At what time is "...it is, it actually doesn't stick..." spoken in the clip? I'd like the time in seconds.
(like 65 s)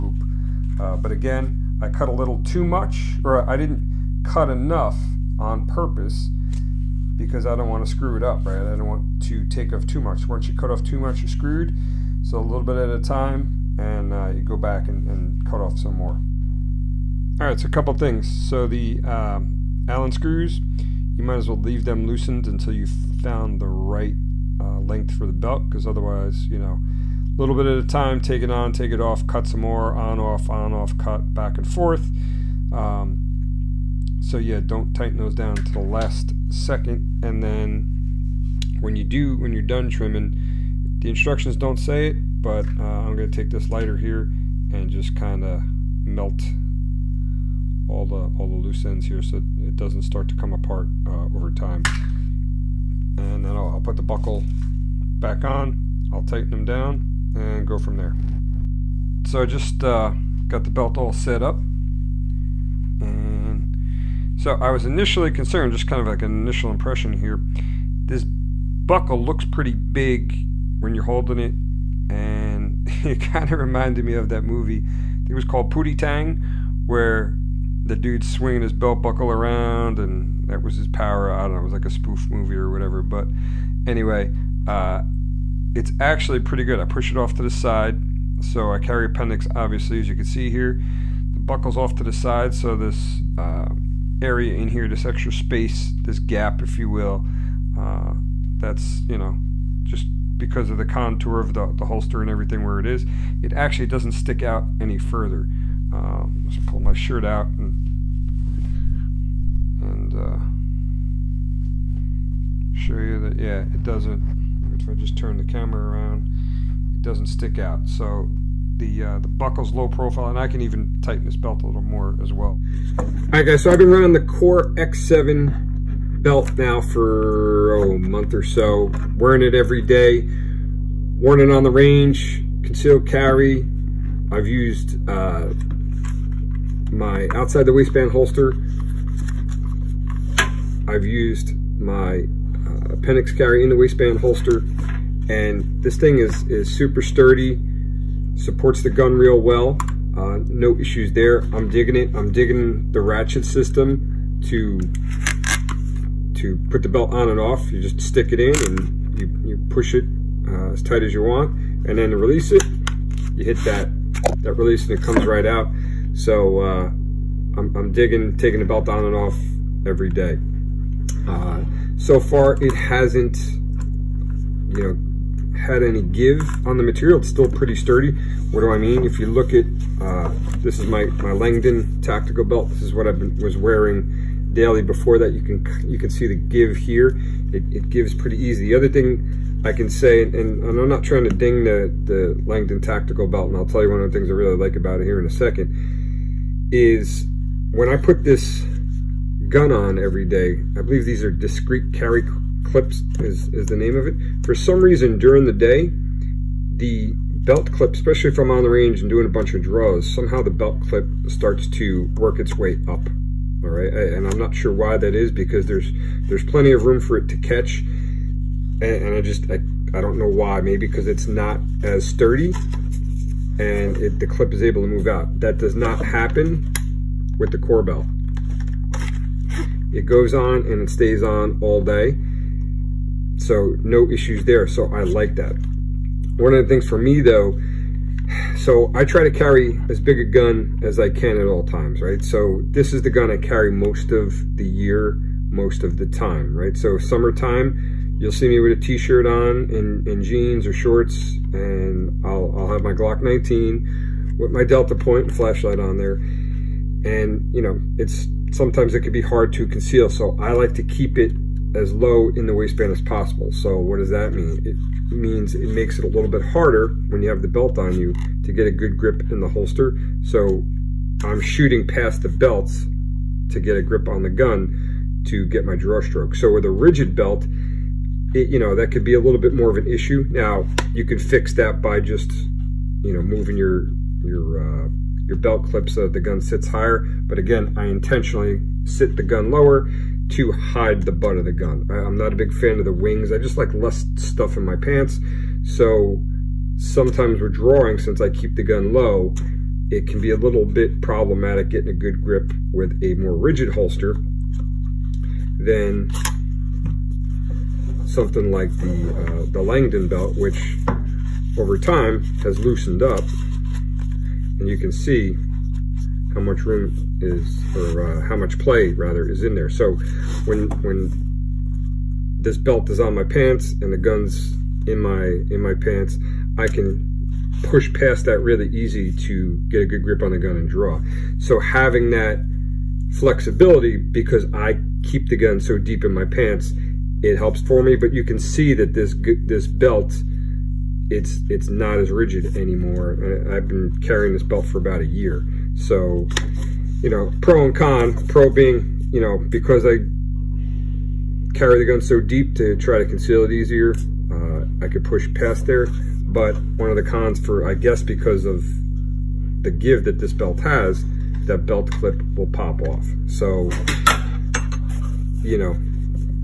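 102 s.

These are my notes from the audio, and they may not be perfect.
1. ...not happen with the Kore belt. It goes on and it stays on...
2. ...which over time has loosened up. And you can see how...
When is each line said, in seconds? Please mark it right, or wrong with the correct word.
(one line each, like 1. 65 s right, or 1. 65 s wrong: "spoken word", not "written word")
1. 225 s right
2. 310 s right.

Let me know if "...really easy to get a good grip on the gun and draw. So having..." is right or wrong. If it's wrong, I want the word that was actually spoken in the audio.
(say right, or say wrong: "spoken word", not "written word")
right.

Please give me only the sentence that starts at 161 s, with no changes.
And then to release it, you hit that, that release and it comes right out.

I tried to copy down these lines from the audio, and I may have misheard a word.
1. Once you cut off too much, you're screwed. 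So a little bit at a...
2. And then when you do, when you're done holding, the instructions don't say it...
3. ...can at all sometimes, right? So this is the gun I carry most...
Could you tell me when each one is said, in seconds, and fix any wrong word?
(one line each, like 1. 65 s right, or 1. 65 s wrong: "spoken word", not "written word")
1. 10 s right
2. 37 s wrong: "trimming", not "holding"
3. 241 s wrong: "times", not "sometimes".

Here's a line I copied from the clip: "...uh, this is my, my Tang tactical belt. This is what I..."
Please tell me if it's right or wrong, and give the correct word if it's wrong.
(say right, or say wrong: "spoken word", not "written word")
wrong: "Langdon", not "Tang".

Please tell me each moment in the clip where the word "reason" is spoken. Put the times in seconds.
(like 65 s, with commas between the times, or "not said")
204 s.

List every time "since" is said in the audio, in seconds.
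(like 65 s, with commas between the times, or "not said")
297 s.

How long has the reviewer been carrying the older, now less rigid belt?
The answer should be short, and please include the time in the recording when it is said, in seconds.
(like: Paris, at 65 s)
about a year, at 344 s.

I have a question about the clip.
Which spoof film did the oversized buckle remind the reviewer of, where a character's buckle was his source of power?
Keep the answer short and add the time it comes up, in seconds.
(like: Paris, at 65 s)
Pootie Tang, at 75 s.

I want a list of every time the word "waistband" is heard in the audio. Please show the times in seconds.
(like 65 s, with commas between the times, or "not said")
137 s, 143 s, 262 s.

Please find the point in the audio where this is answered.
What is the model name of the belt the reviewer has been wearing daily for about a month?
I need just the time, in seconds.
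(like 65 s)
124 s.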